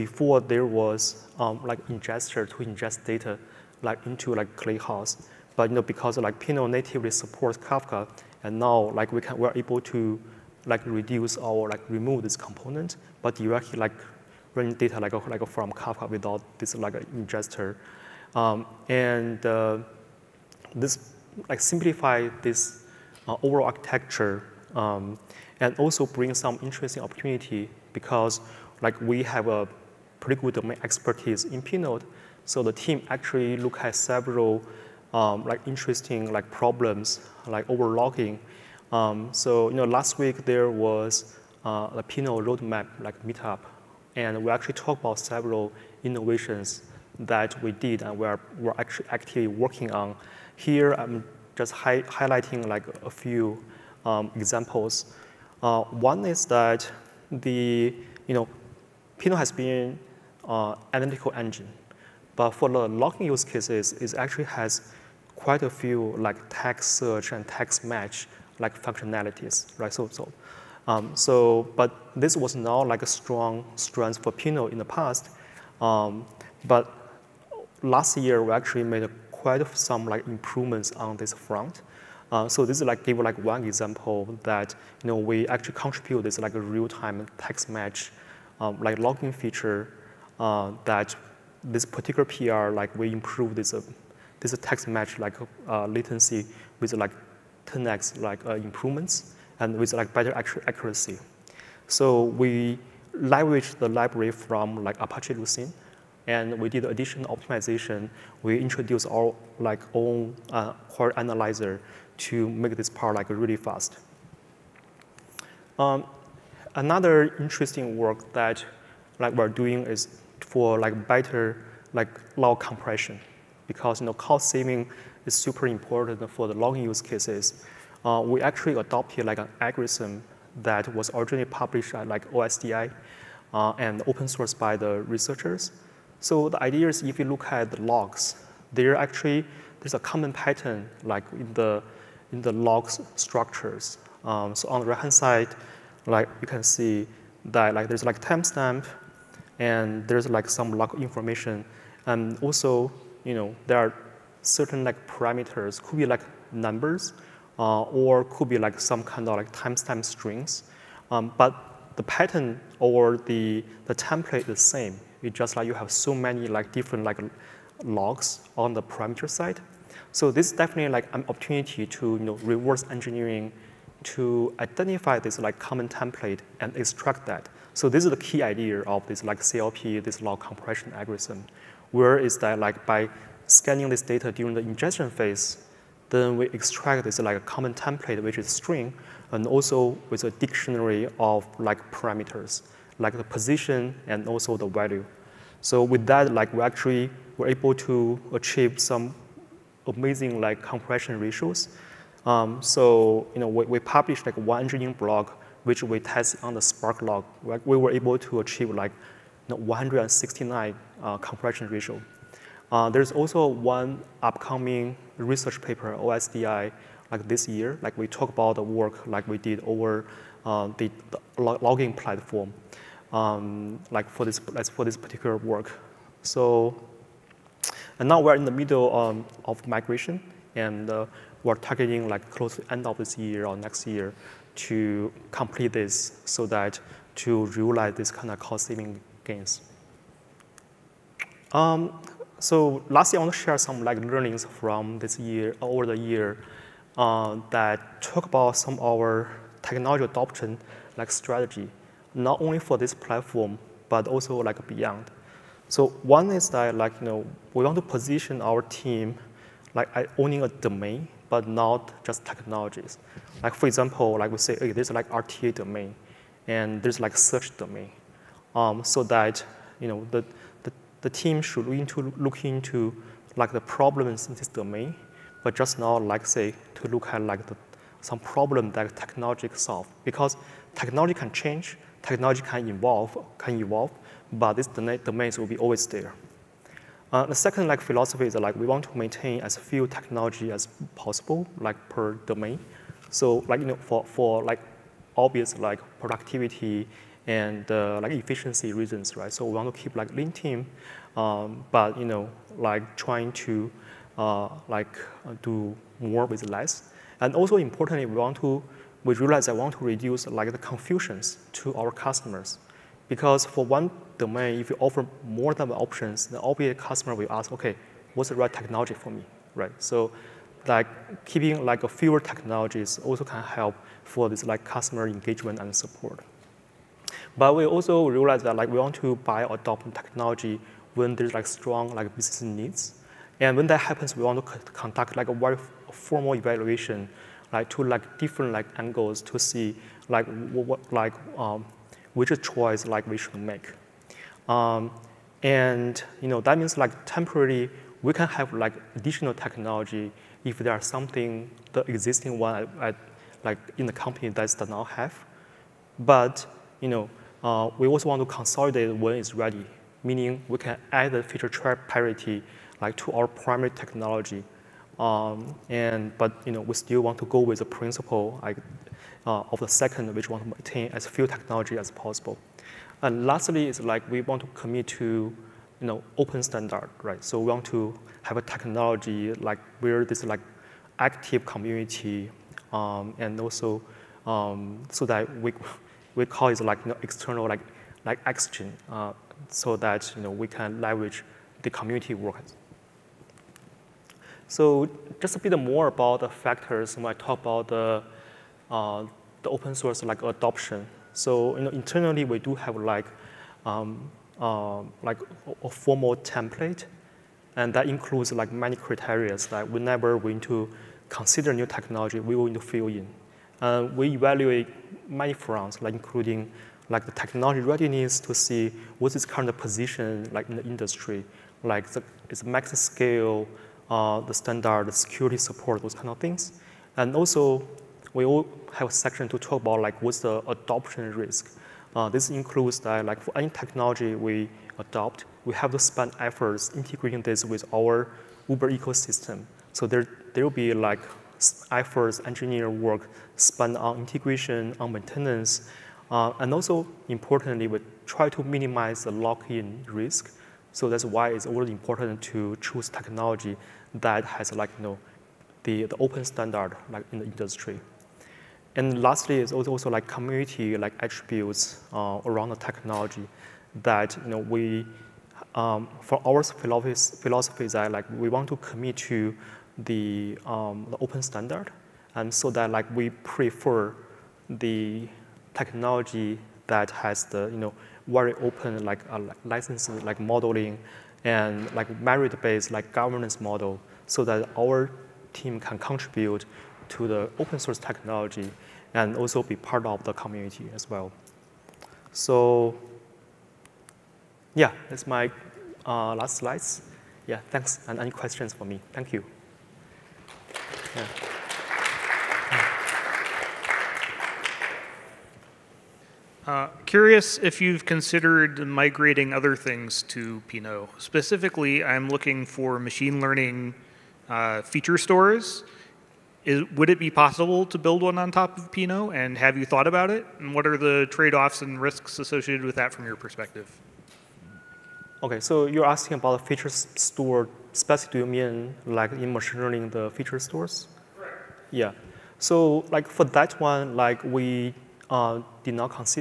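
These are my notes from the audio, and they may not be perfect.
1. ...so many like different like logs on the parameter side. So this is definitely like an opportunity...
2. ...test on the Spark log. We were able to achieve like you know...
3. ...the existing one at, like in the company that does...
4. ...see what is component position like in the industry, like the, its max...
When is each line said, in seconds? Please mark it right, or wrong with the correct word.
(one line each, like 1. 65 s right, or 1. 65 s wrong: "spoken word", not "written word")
1. 165 s right
2. 205 s right
3. 351 s right
4. 418 s wrong: "current", not "component".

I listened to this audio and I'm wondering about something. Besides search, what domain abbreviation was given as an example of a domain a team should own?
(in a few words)
RTA.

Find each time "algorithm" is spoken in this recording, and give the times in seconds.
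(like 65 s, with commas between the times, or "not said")
129 s, 180 s.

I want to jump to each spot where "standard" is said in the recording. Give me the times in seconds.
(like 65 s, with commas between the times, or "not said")
376 s, 424 s, 456 s, 471 s.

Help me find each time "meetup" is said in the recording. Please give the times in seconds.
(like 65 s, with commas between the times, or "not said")
43 s.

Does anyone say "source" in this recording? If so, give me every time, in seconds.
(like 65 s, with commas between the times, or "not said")
134 s, 399 s, 487 s.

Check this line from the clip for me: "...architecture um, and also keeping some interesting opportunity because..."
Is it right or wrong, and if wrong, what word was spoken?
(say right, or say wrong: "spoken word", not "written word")
wrong: "bring", not "keeping".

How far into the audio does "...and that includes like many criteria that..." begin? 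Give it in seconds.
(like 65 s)
407 s.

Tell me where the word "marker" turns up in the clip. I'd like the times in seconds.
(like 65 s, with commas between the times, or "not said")
not said.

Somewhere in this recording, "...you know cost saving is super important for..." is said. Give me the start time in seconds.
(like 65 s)
124 s.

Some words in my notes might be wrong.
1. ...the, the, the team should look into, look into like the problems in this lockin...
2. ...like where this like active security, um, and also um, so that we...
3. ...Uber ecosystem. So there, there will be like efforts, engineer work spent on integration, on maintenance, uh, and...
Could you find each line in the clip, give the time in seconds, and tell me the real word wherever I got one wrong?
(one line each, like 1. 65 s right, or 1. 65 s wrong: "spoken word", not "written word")
1. 270 s wrong: "domain", not "lockin"
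2. 379 s wrong: "community", not "security"
3. 438 s right.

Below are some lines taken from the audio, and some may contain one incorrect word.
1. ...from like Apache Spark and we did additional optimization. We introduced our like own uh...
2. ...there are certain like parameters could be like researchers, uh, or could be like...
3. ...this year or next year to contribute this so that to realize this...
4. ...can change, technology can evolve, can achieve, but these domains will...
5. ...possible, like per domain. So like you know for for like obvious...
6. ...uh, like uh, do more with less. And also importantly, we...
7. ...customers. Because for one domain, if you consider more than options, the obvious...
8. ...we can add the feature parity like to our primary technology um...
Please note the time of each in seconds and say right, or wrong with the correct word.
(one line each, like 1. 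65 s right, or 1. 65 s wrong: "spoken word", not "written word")
1. 104 s wrong: "Lucene", not "Spark"
2. 153 s wrong: "numbers", not "researchers"
3. 232 s wrong: "complete", not "contribute"
4. 281 s wrong: "evolve", not "achieve"
5. 290 s right
6. 304 s right
7. 311 s wrong: "offer", not "consider"
8. 360 s right.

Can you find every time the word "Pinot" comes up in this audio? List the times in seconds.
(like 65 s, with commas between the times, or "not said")
6 s, 31 s, 42 s, 59 s, 74 s, 510 s, 518 s.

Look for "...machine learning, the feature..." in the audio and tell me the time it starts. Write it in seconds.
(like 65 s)
529 s.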